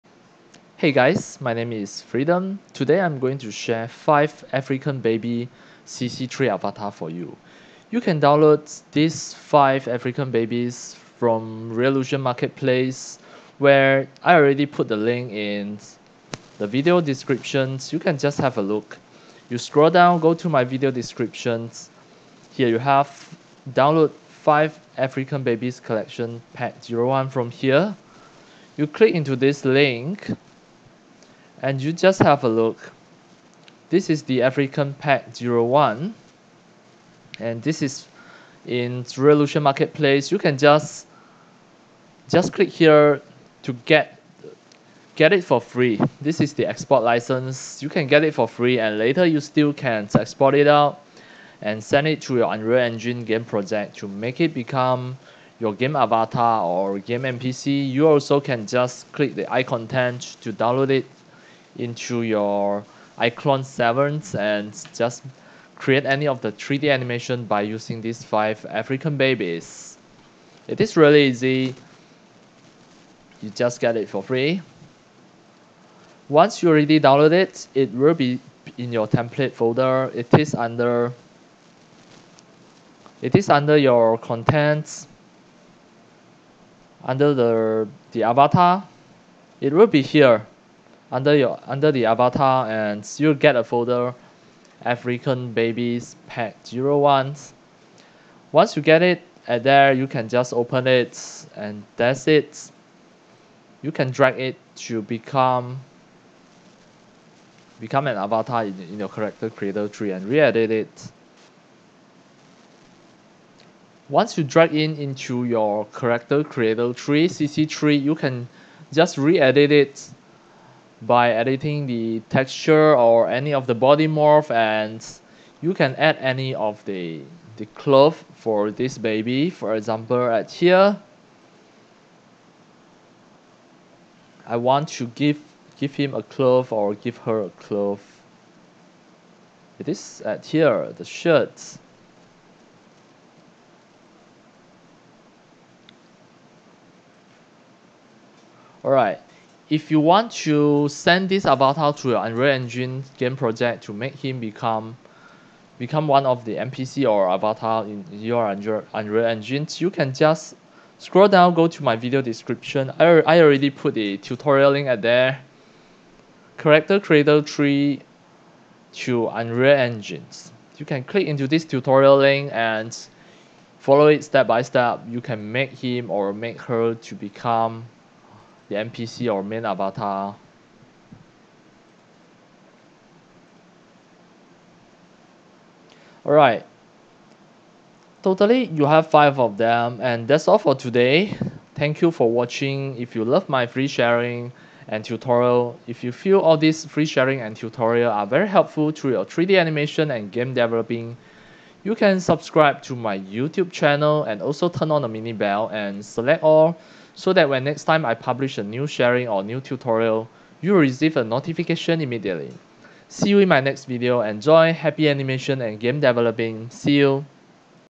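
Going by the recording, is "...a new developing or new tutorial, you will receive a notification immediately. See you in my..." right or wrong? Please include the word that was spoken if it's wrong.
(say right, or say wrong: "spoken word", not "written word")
wrong: "sharing", not "developing".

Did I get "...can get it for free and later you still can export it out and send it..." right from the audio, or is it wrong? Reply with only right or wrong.
right.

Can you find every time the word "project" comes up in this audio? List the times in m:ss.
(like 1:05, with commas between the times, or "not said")
0:53, 2:33.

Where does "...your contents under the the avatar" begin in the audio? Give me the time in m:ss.
1:23.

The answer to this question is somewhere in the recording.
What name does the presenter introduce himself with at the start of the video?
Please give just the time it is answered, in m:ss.
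0:02.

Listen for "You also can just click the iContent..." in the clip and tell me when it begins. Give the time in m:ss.
0:57.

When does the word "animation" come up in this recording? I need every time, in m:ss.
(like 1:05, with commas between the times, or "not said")
1:06, 3:19, 3:35.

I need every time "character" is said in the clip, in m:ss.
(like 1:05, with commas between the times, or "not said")
1:49, 1:55, 2:46.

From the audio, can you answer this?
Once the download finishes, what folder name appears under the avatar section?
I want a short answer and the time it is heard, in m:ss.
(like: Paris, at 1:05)
African babies pack 01, at 1:34.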